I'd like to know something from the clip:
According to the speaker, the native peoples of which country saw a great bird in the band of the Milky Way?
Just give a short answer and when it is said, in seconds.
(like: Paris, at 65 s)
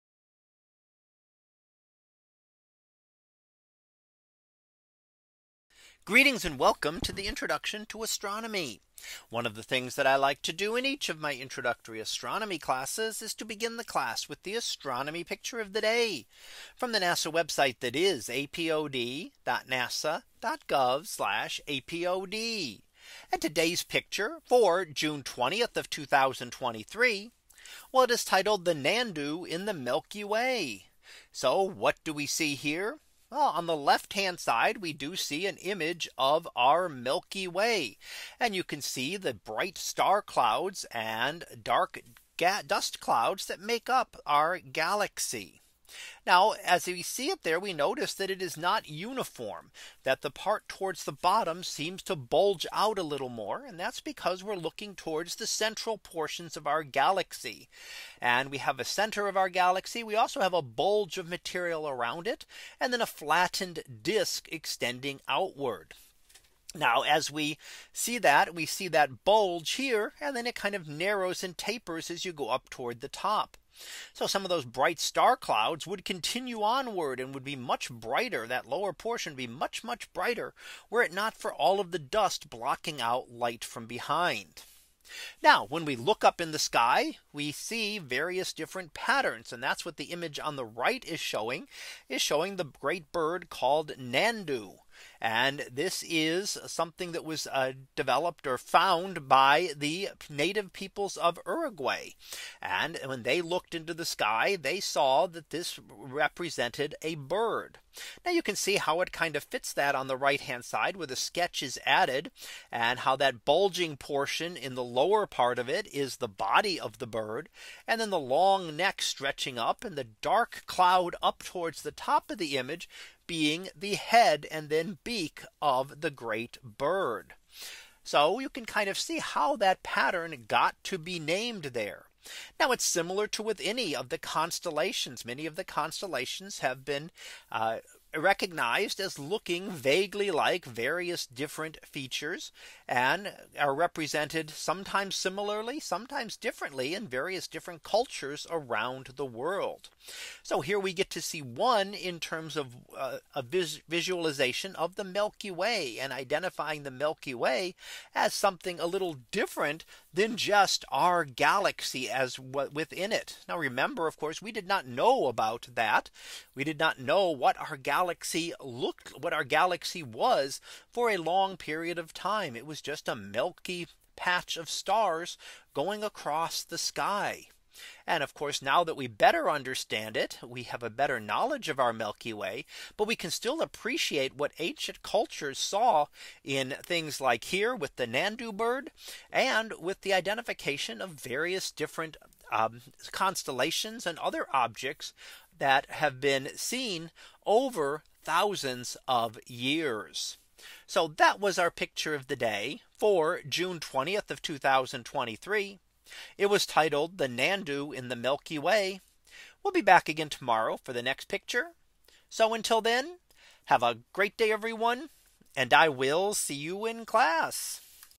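Uruguay, at 101 s.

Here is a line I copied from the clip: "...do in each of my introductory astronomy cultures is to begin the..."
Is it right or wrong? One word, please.
wrong.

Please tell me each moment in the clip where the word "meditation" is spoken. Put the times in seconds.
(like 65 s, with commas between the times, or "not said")
not said.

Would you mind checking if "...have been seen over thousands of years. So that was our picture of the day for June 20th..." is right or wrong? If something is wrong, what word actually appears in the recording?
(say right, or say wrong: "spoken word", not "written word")
right.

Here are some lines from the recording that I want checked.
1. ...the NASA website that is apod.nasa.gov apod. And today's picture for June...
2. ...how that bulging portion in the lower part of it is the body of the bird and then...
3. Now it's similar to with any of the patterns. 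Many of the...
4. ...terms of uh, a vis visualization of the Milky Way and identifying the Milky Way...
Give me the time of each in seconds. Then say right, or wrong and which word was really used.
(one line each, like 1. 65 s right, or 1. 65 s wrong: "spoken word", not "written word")
1. 16 s right
2. 112 s right
3. 132 s wrong: "constellations", not "patterns"
4. 152 s right.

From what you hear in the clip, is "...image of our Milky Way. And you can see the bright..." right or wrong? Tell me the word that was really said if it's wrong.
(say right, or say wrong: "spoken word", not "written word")
right.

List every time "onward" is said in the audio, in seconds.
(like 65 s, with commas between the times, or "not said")
76 s.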